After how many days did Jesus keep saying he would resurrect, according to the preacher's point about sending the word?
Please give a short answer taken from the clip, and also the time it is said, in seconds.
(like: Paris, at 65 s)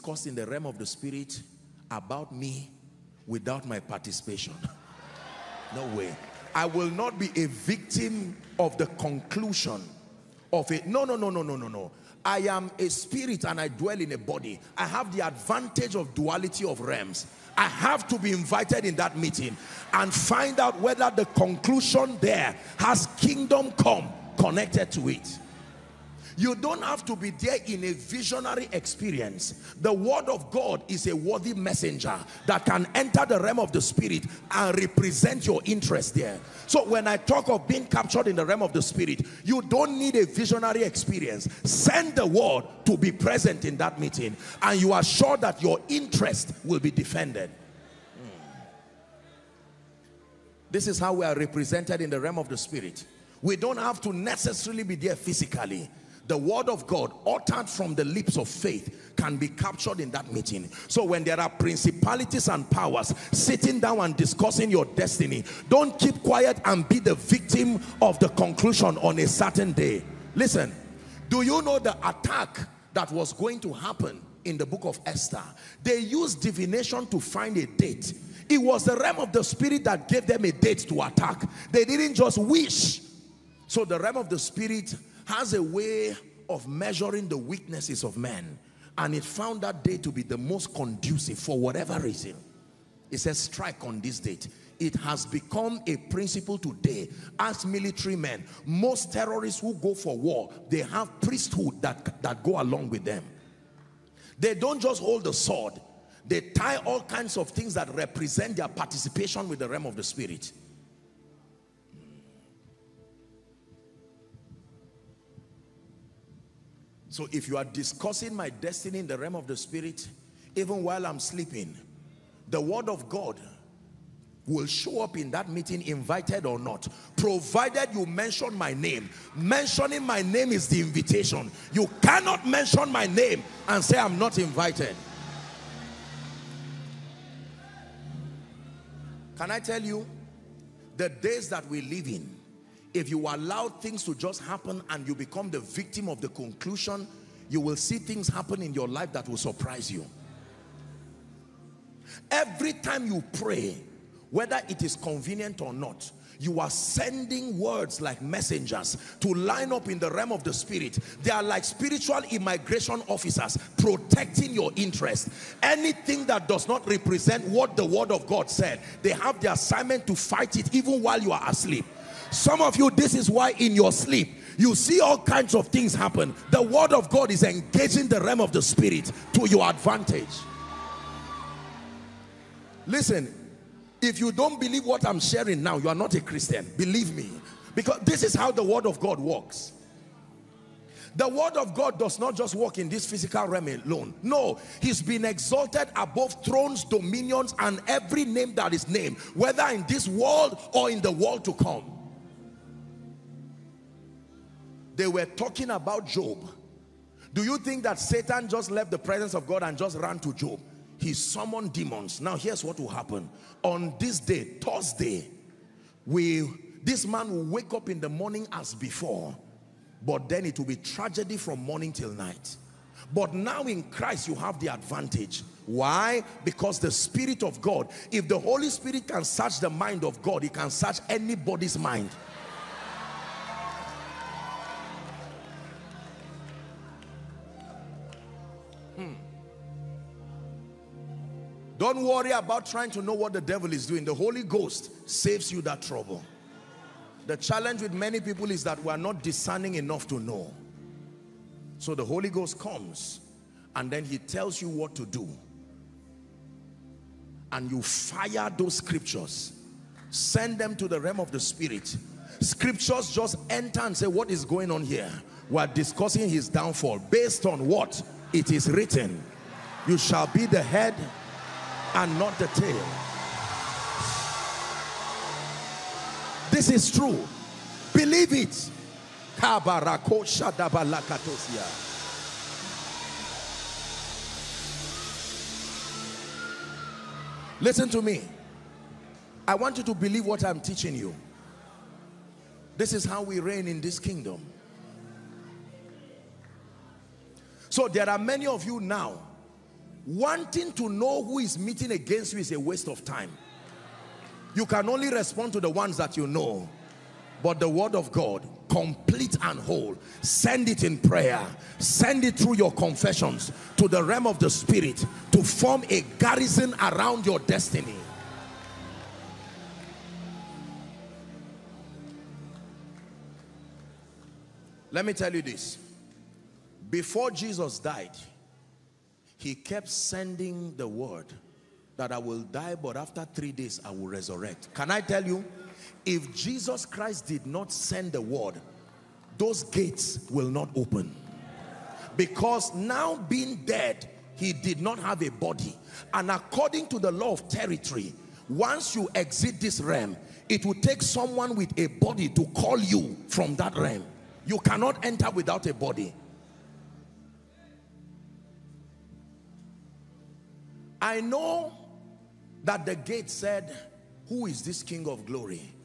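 3, at 333 s.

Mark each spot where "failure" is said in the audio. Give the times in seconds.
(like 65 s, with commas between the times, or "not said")
not said.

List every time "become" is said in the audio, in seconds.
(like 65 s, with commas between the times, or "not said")
95 s, 145 s.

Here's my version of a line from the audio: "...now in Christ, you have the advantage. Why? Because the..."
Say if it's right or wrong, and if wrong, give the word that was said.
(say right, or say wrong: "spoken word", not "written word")
right.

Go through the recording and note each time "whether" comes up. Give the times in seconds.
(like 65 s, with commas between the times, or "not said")
20 s, 154 s, 199 s.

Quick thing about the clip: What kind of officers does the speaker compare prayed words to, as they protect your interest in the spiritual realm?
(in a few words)
spiritual immigration officers.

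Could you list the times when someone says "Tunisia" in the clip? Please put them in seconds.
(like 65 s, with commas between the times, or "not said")
not said.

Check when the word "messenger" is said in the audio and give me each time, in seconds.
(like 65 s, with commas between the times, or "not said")
31 s, 158 s.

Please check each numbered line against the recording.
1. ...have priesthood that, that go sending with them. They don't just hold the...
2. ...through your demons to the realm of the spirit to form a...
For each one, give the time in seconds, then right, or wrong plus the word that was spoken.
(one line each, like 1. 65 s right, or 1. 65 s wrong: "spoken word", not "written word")
1. 100 s wrong: "along", not "sending"
2. 312 s wrong: "confessions", not "demons".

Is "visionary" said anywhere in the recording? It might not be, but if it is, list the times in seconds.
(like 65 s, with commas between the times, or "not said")
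27 s, 40 s.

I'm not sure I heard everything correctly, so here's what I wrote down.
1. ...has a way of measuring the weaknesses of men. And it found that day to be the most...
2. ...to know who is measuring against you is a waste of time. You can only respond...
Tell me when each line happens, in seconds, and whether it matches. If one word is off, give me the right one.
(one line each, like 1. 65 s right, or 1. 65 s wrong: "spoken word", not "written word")
1. 85 s right
2. 300 s wrong: "meeting", not "measuring".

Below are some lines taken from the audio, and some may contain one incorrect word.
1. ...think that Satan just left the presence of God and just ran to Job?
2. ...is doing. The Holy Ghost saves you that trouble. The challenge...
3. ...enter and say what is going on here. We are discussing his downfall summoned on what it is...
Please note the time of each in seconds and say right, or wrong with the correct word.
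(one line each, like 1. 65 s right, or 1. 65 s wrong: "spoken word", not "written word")
1. 207 s right
2. 243 s right
3. 263 s wrong: "based", not "summoned".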